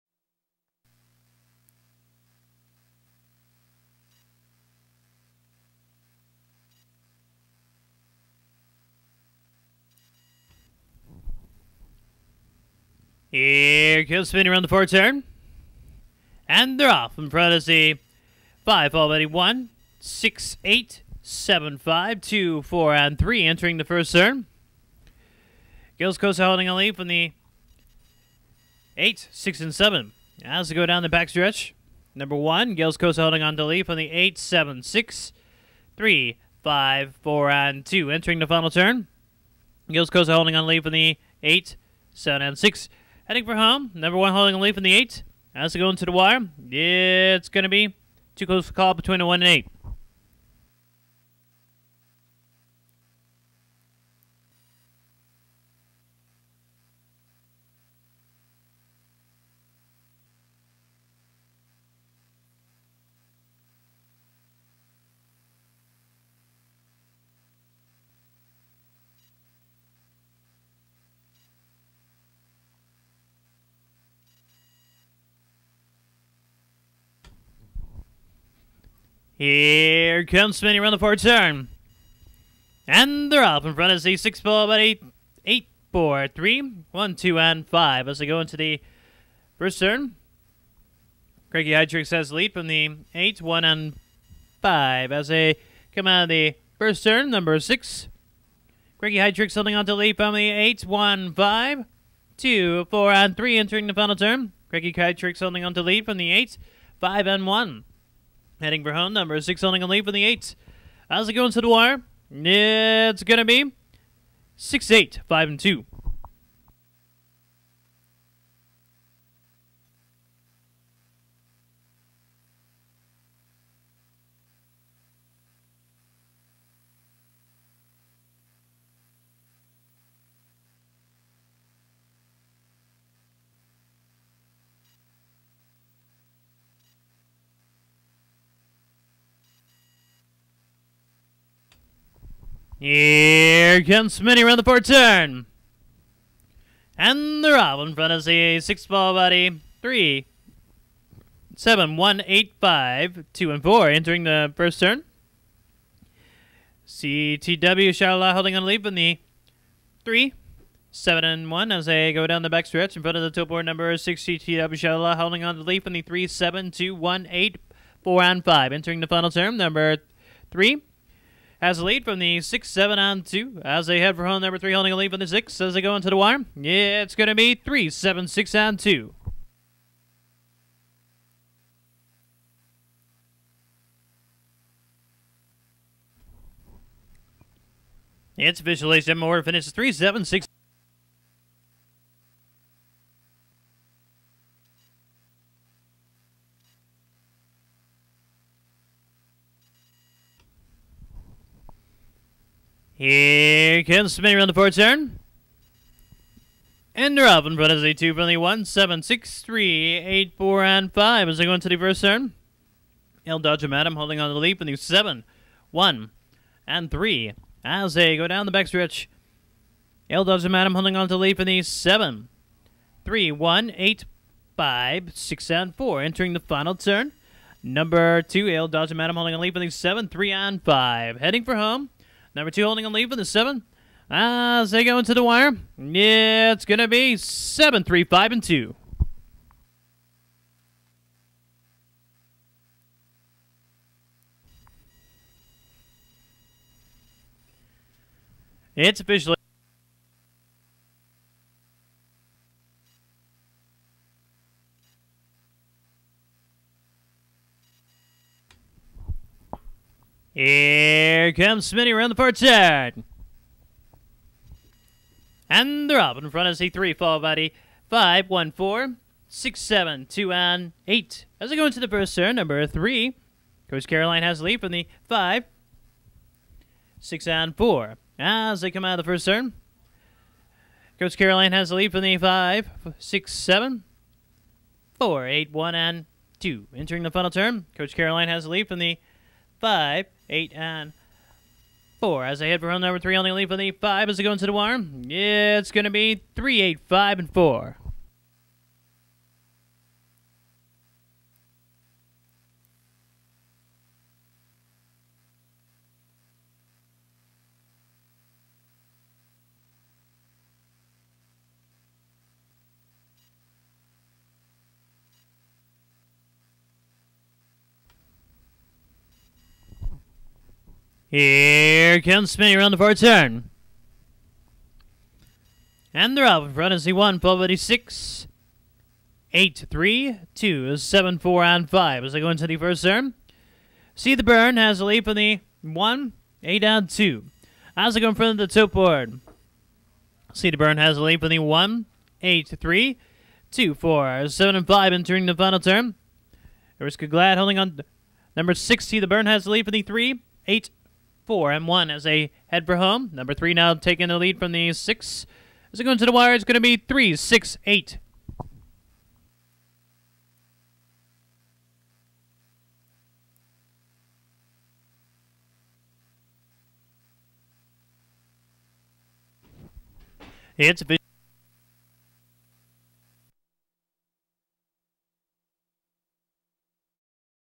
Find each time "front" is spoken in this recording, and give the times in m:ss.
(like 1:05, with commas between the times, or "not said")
0:17, 1:23, 2:27, 2:43, 3:27, 4:26, 5:26, 5:38.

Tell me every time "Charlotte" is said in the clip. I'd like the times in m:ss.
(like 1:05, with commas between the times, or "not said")
2:37, 2:44.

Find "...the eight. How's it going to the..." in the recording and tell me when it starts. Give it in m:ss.
1:50.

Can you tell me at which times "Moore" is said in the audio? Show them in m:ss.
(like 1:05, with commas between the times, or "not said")
3:09.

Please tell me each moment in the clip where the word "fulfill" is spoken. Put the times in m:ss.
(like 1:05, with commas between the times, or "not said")
not said.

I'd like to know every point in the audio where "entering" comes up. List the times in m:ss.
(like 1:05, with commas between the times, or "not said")
0:23, 0:38, 1:43, 2:33, 2:48, 3:46, 4:46, 5:44.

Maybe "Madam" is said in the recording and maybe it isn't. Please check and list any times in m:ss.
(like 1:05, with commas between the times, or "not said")
3:33, 3:40, 3:48.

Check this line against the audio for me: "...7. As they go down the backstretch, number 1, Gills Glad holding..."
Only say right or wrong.
wrong.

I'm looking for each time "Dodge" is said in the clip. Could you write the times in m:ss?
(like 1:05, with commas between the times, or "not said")
3:33, 3:40, 3:48.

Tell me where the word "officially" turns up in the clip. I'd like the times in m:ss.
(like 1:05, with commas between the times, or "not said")
3:08, 4:08.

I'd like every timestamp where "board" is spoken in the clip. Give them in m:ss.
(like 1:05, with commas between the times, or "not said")
2:43, 5:38.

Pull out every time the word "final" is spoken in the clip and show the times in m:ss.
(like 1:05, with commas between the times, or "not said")
0:38, 1:43, 2:49, 3:46, 4:47, 5:45.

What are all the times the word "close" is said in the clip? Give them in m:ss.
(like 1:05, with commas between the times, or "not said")
0:48.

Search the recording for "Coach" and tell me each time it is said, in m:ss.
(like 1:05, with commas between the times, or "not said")
4:33, 4:40, 4:47.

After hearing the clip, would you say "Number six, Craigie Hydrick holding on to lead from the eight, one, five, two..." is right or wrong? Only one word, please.
right.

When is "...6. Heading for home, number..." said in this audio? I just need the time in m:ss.
0:42.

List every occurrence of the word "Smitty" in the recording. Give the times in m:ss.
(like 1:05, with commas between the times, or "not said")
1:20, 2:24, 4:21.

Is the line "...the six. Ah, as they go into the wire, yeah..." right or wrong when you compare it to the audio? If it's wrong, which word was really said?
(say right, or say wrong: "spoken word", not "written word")
wrong: "seven", not "six".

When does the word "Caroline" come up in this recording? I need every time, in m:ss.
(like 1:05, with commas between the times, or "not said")
4:33, 4:41, 4:47.